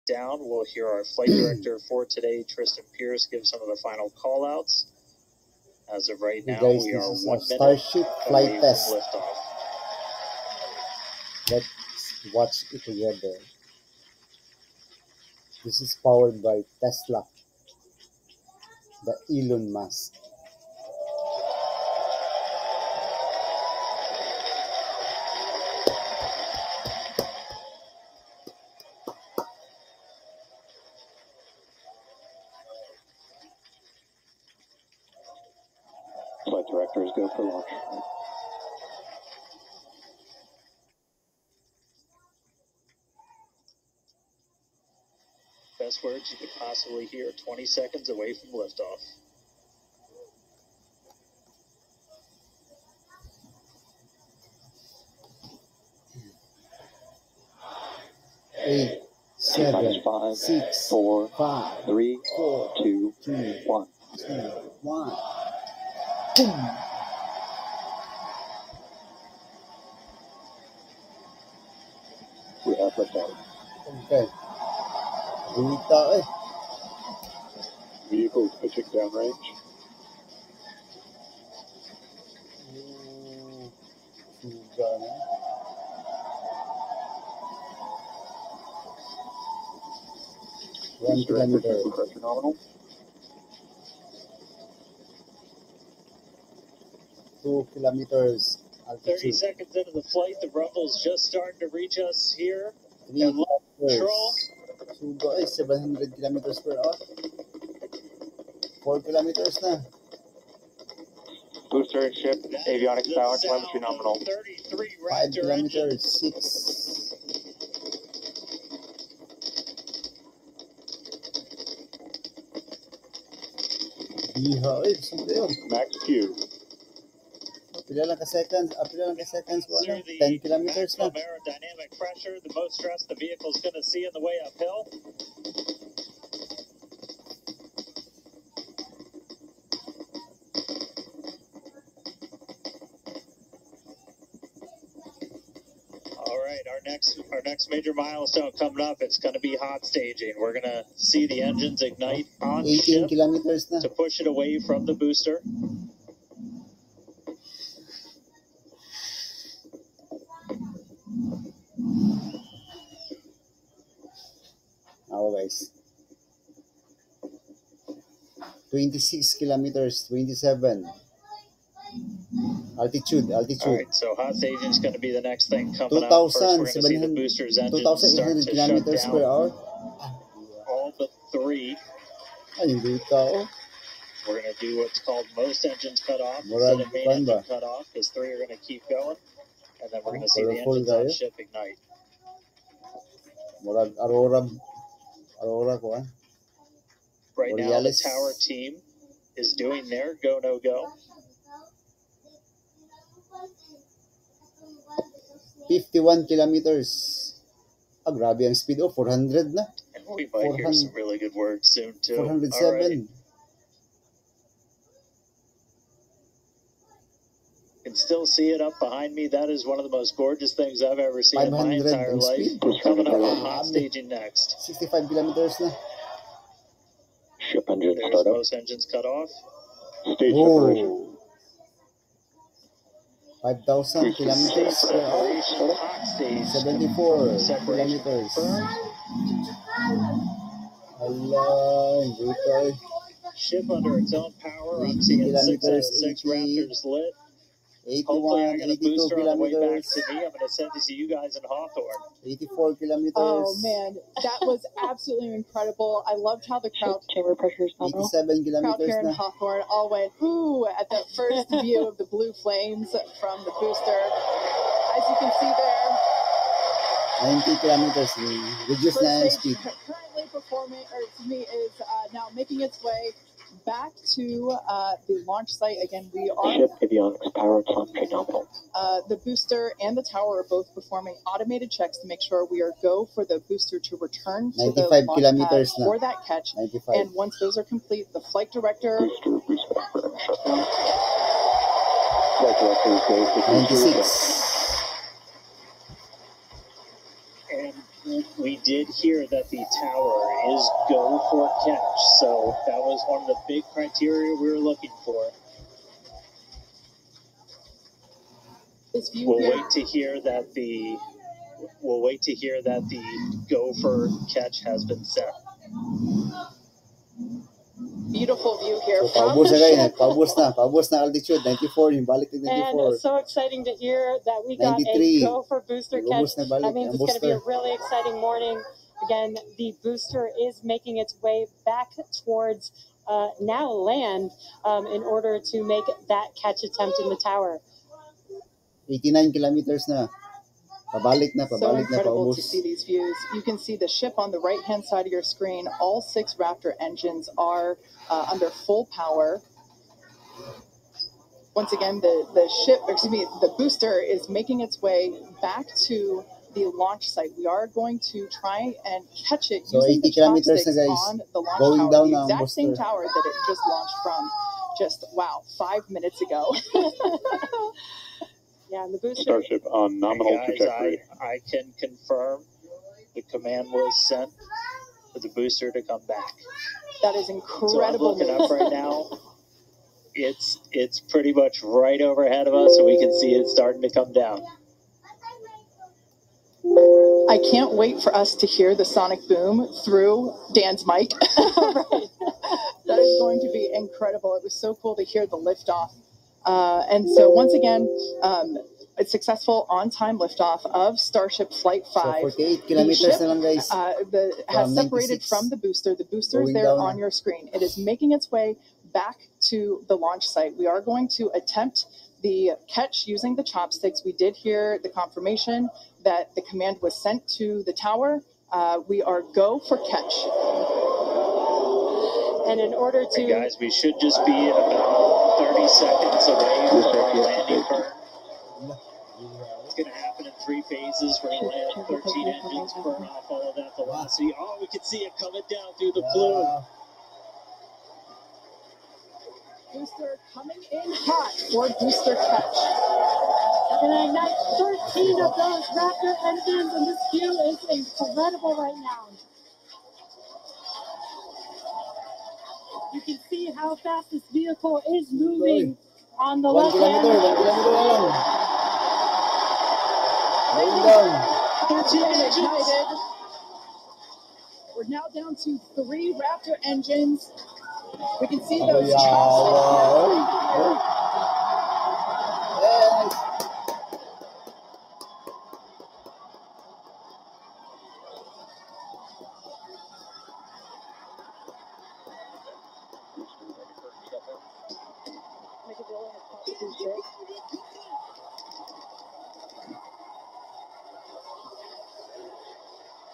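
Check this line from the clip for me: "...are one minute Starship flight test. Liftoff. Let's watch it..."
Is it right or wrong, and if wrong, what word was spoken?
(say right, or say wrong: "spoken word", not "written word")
right.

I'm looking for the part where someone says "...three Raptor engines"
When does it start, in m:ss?
7:45.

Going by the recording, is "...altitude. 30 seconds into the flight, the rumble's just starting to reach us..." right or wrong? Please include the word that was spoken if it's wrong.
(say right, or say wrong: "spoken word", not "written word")
right.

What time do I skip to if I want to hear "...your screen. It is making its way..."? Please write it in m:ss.
6:46.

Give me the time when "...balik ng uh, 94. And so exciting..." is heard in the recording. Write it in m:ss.
5:22.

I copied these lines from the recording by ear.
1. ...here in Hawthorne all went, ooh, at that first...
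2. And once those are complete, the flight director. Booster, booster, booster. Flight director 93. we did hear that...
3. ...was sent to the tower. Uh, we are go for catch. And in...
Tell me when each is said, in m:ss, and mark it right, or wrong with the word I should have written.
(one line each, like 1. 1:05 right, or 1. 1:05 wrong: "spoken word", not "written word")
1. 4:18 right
2. 4:46 wrong: "96", not "93"
3. 6:56 right.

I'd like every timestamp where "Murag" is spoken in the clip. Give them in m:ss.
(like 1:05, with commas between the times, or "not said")
3:06, 3:13.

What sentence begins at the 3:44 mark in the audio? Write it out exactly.
65 kilometers Ship engine There's startup.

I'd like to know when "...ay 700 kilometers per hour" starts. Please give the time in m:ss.
1:45.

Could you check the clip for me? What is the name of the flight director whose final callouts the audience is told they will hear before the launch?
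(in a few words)
Tristan Pierce.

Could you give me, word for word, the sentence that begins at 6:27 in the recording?
I can't wait for us to hear the sonic boom through Dan's mic.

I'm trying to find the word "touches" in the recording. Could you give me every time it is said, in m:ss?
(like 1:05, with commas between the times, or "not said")
not said.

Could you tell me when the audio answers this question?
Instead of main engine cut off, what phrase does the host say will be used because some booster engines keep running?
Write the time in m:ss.
3:05.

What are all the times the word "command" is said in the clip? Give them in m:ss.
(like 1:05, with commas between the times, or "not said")
6:13, 6:56.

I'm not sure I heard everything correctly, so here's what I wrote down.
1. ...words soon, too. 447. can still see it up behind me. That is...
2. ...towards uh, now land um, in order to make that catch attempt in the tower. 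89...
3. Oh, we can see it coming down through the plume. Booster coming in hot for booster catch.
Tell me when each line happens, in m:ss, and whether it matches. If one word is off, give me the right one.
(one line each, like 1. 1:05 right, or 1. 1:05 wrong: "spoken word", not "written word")
1. 3:31 wrong: "407", not "447"
2. 5:32 right
3. 7:14 right.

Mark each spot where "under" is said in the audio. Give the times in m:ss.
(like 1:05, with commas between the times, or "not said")
4:03, 5:48.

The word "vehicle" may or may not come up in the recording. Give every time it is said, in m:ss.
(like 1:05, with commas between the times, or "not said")
2:13, 7:34.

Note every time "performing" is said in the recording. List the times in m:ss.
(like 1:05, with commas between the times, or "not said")
4:30, 4:40.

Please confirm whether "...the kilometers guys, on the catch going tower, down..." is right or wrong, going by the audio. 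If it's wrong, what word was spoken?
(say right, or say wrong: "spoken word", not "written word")
wrong: "launch", not "catch".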